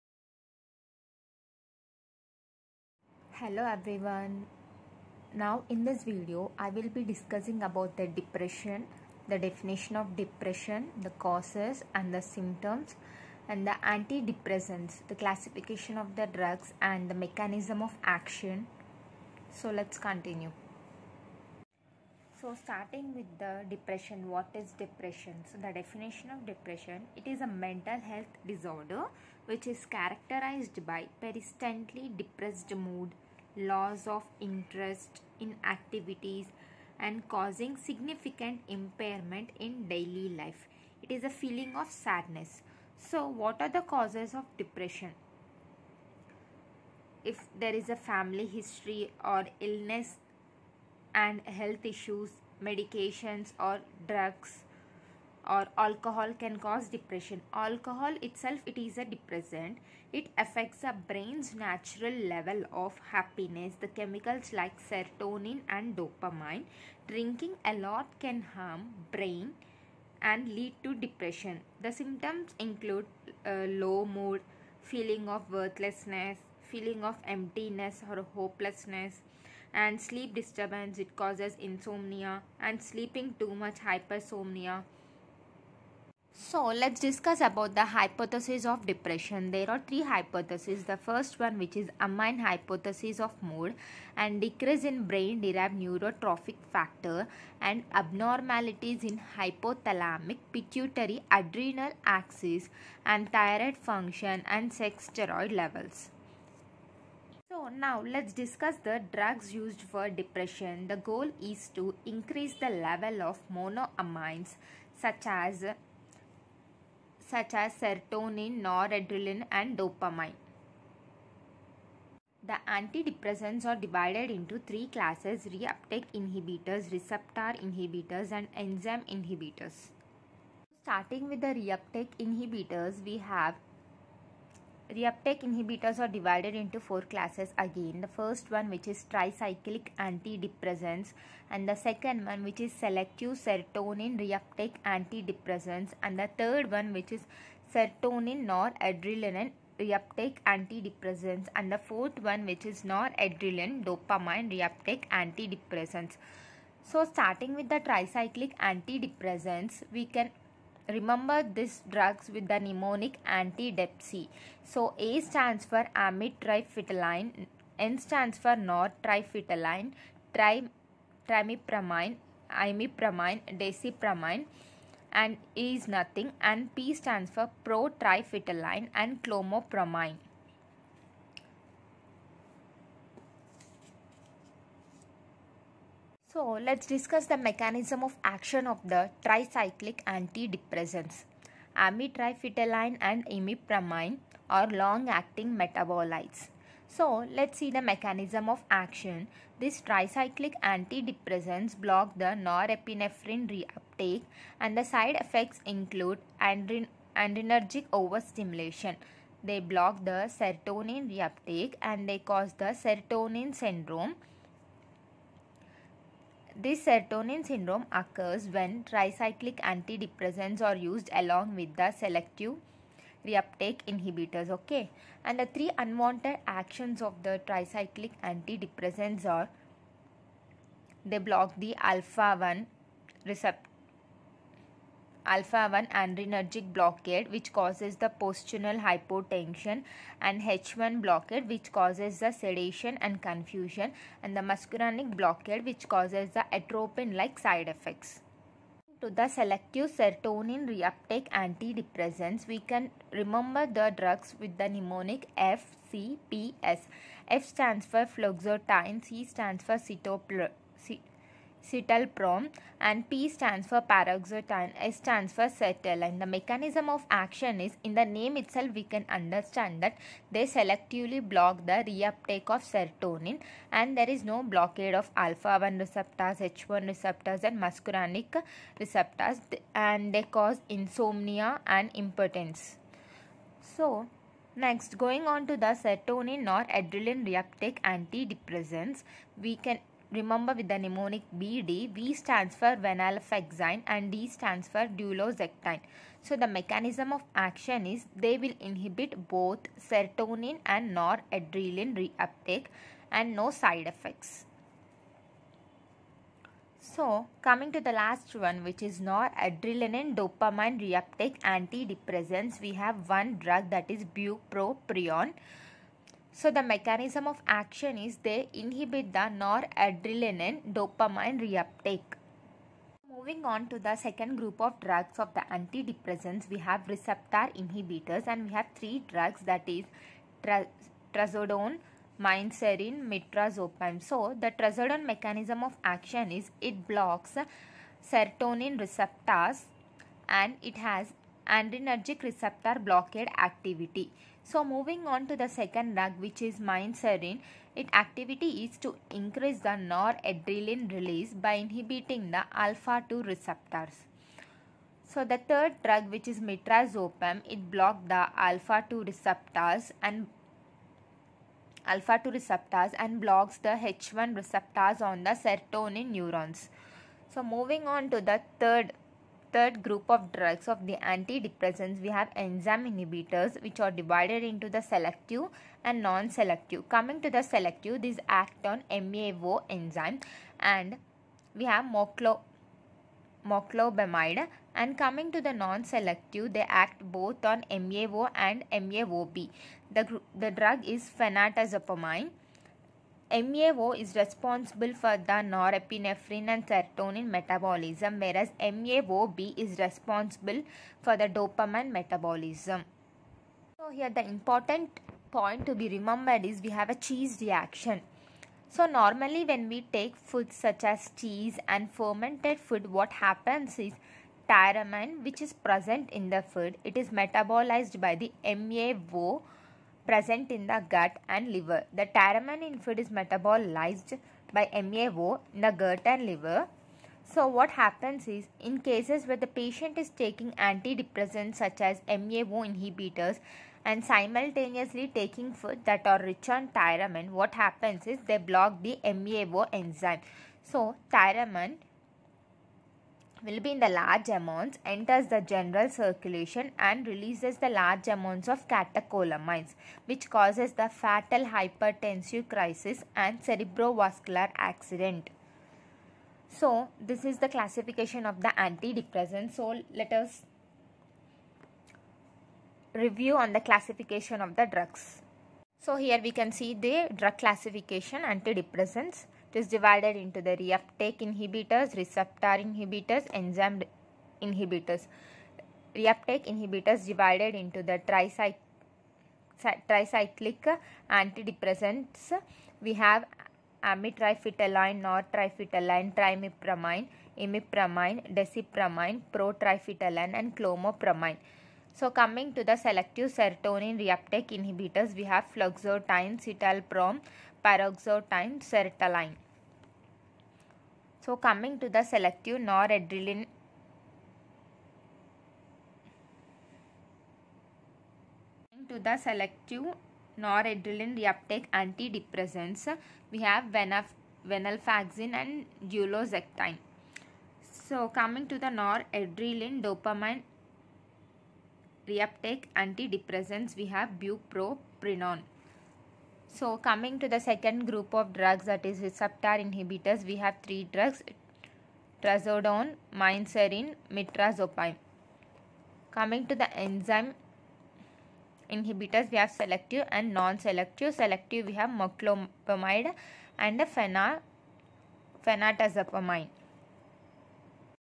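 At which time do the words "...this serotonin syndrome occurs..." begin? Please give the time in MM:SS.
03:36.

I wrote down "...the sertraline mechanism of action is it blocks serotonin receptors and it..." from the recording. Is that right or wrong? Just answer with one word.
wrong.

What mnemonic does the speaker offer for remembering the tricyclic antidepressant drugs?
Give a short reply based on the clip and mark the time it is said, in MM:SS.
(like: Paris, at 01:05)
anti-depsey, at 02:43.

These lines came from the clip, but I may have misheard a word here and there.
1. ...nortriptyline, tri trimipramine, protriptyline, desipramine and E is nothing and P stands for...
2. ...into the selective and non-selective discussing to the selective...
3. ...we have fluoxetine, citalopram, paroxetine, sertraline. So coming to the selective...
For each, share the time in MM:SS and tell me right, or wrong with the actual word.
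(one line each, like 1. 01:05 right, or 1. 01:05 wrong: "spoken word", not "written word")
1. 02:48 wrong: "imipramine", not "protriptyline"
2. 06:14 wrong: "coming", not "discussing"
3. 08:15 right.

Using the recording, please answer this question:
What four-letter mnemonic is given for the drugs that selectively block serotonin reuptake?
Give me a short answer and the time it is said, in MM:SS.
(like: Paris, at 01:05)
FCPS, at 04:15.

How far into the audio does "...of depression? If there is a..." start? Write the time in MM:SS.
00:44.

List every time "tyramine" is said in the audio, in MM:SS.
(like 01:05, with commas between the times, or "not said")
06:54, 07:02, 07:16, 07:21.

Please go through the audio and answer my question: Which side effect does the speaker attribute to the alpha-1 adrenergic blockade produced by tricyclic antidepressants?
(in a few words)
postural hypotension.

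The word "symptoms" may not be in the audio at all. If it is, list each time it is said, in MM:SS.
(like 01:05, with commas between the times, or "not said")
00:12, 01:11.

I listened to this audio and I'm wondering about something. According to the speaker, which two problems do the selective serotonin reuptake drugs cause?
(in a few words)
insomnia and impotence.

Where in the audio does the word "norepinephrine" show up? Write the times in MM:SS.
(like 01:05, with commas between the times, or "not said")
03:22, 06:35.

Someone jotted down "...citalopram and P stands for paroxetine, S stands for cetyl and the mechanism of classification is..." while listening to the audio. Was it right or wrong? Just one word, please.
wrong.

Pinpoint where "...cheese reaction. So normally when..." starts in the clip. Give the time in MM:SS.
06:46.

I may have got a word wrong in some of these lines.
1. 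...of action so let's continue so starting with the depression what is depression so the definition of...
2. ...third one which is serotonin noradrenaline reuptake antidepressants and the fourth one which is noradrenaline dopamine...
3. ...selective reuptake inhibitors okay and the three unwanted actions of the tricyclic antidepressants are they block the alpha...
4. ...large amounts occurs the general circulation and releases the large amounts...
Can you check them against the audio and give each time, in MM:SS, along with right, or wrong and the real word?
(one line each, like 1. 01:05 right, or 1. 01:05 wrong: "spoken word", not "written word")
1. 00:17 right
2. 02:26 right
3. 03:41 right
4. 07:23 wrong: "enters", not "occurs".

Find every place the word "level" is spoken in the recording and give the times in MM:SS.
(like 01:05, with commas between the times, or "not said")
01:02, 01:45, 01:52.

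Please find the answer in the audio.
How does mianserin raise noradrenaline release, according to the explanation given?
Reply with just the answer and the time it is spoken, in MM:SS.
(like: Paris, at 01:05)
by inhibiting alpha 2 receptors, at 05:51.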